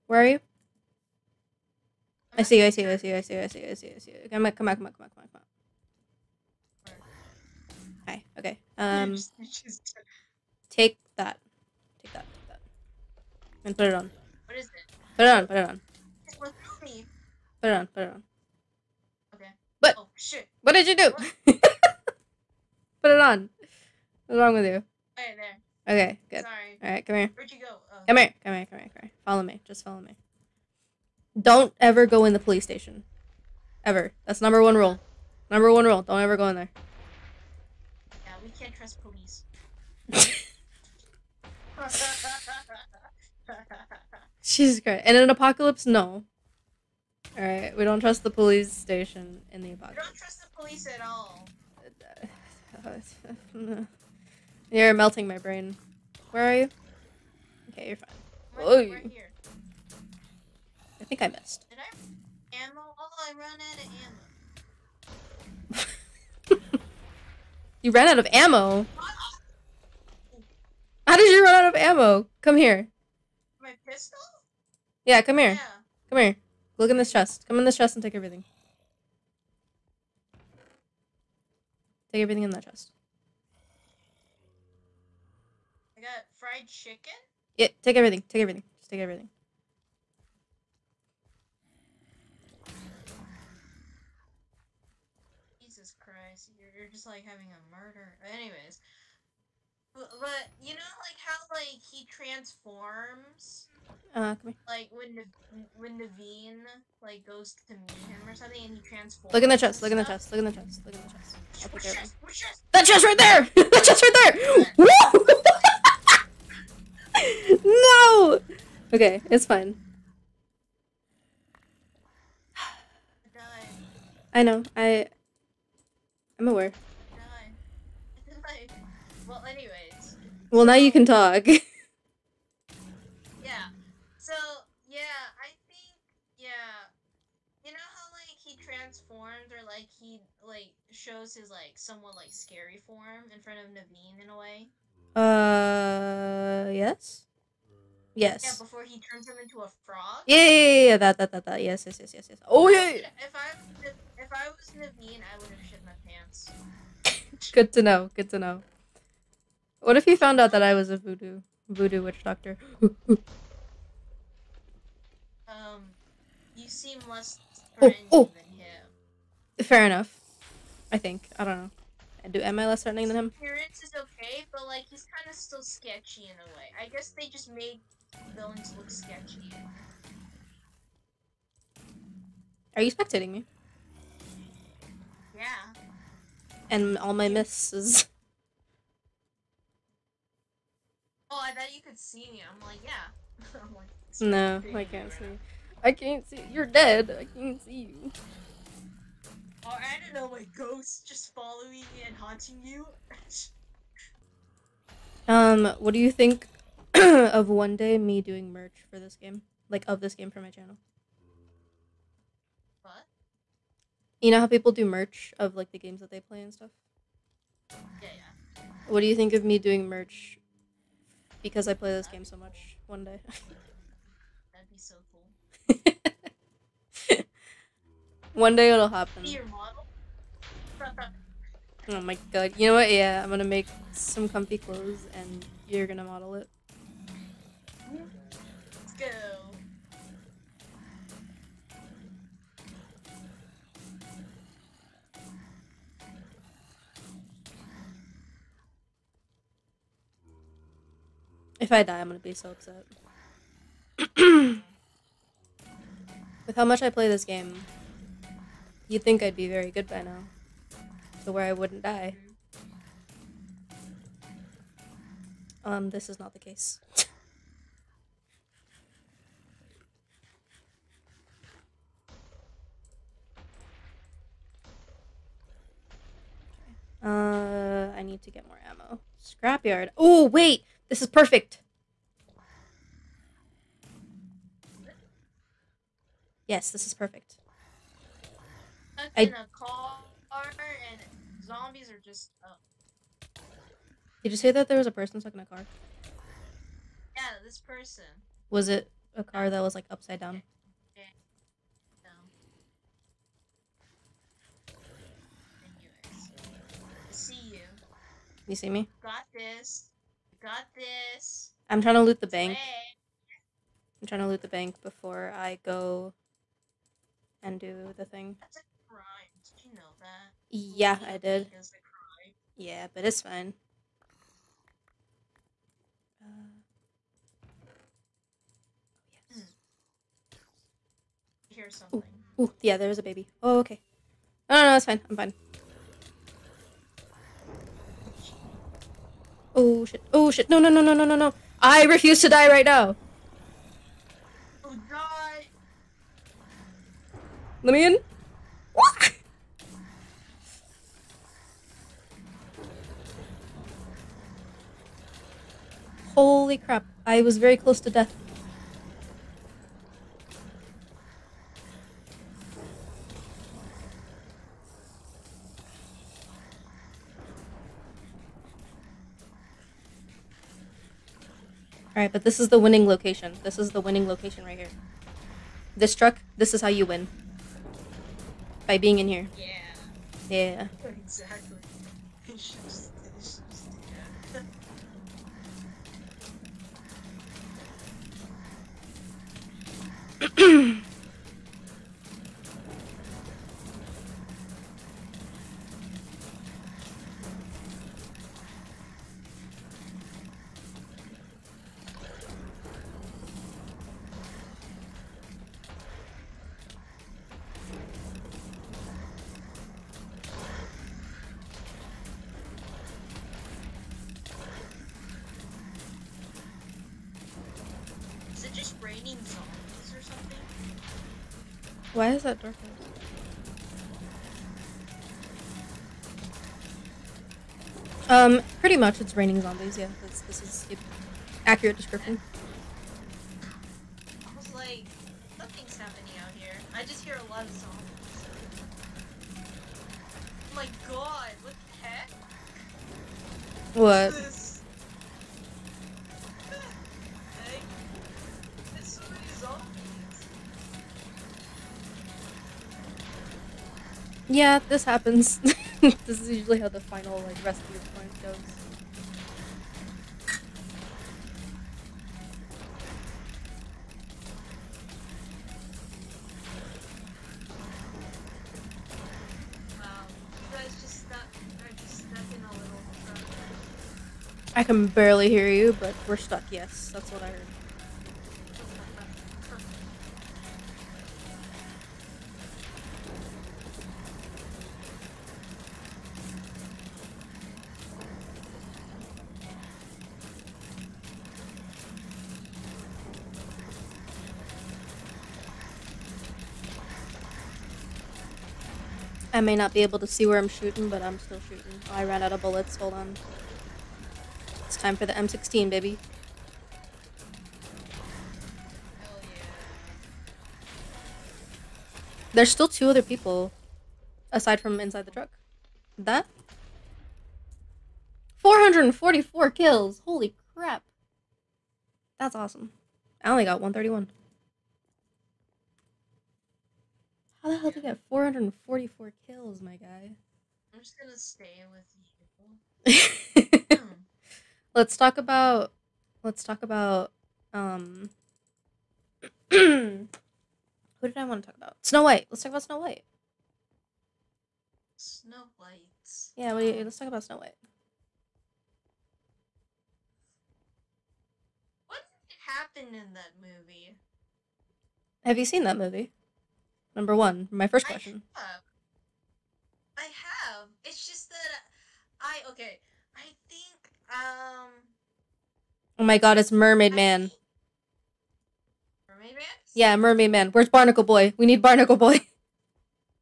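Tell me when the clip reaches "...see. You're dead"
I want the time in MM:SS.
03:16.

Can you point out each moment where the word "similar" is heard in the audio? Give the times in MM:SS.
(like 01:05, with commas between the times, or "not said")
not said.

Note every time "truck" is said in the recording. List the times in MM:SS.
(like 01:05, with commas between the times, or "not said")
06:15, 08:35.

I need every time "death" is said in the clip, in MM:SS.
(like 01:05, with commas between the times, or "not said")
05:57.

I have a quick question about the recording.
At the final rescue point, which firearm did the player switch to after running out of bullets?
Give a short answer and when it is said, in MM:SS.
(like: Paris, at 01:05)
M16, at 08:25.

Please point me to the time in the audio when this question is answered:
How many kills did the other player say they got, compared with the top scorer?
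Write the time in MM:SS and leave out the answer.
08:43.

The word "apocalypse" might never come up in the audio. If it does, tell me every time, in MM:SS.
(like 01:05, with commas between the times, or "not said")
00:45, 00:49.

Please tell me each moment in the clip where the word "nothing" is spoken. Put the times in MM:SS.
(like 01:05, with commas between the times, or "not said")
07:15.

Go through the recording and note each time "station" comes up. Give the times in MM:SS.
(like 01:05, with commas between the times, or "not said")
00:32, 00:48.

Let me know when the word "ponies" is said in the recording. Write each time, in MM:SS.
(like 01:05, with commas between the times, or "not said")
00:39.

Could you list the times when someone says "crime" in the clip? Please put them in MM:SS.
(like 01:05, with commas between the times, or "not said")
05:18.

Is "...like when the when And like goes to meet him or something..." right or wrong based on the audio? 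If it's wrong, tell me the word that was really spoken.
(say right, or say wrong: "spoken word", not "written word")
wrong: "Naveen", not "And".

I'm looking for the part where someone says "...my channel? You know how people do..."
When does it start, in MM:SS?
03:30.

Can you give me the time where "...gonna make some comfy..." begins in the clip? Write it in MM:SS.
03:53.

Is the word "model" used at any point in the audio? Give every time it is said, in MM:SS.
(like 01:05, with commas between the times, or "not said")
03:49, 03:56.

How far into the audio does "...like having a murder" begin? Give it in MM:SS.
01:37.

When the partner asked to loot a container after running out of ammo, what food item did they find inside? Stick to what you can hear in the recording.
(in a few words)
fried chicken.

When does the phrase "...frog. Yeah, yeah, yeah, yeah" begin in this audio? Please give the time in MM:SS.
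02:29.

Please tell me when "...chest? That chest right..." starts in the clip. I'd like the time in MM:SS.
01:52.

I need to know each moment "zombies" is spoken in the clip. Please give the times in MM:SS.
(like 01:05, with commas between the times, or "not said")
04:51, 07:09, 07:17.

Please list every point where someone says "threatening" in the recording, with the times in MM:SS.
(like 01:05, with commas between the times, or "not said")
02:47, 02:52.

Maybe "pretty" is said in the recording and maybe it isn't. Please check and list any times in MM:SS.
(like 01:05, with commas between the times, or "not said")
07:08.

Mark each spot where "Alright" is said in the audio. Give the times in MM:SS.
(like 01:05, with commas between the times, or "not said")
00:47, 06:11.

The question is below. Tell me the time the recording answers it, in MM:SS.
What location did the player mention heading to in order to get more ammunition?
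04:39.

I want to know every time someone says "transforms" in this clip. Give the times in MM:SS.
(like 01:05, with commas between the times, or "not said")
01:42, 01:48, 02:18.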